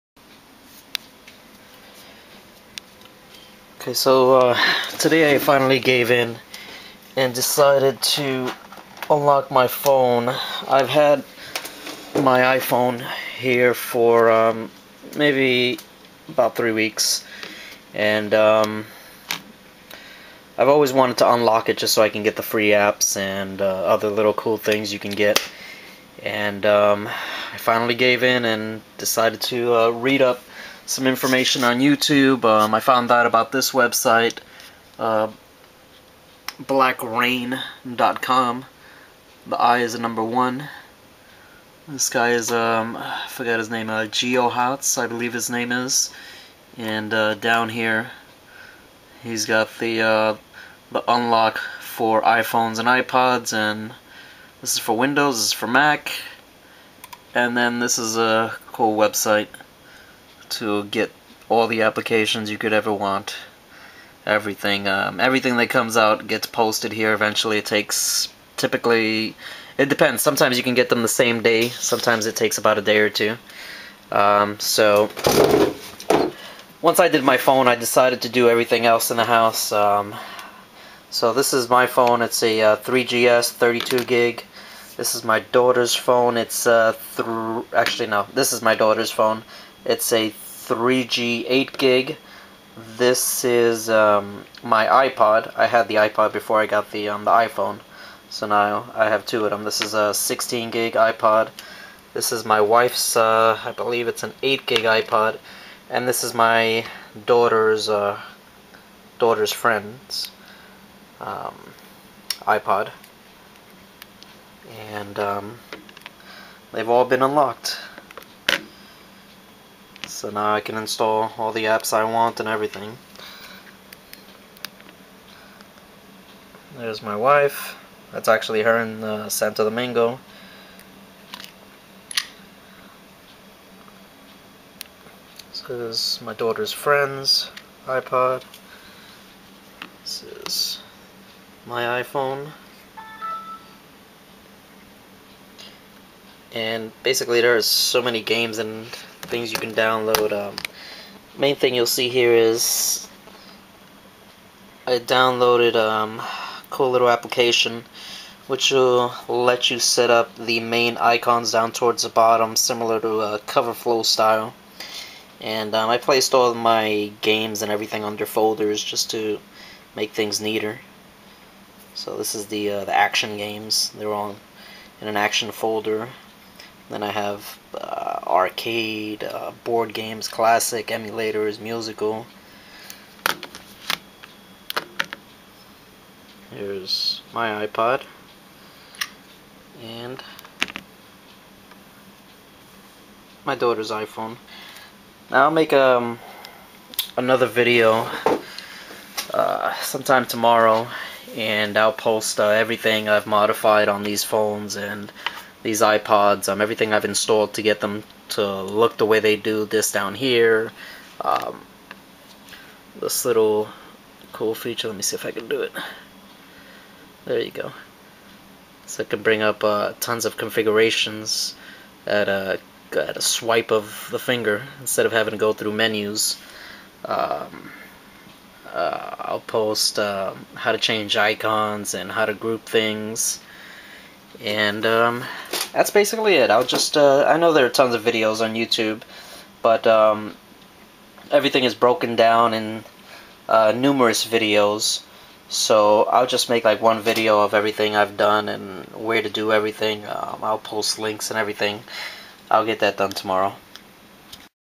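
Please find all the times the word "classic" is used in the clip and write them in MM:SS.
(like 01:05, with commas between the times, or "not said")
03:00.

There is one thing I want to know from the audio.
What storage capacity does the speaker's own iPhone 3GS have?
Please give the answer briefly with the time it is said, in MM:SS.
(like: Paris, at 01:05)
32 gig, at 01:23.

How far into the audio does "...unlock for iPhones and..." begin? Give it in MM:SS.
00:51.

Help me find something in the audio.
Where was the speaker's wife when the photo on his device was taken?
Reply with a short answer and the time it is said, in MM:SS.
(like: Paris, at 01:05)
Santo Domingo, at 02:09.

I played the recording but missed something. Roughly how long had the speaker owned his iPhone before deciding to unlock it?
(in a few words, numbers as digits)
about 3 weeks.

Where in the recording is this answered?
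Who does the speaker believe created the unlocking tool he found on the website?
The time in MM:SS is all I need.
00:44.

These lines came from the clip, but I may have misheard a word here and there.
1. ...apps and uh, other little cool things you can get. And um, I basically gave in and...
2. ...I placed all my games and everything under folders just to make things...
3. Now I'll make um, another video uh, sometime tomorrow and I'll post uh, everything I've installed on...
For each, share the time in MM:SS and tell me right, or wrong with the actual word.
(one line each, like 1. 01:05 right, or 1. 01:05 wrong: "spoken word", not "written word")
1. 00:22 wrong: "finally", not "basically"
2. 02:45 right
3. 03:15 wrong: "modified", not "installed".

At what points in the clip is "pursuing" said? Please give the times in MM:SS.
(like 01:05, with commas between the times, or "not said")
not said.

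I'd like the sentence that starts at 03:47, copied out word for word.
Um, uh, I'll post uh, how to change icons and how to group things.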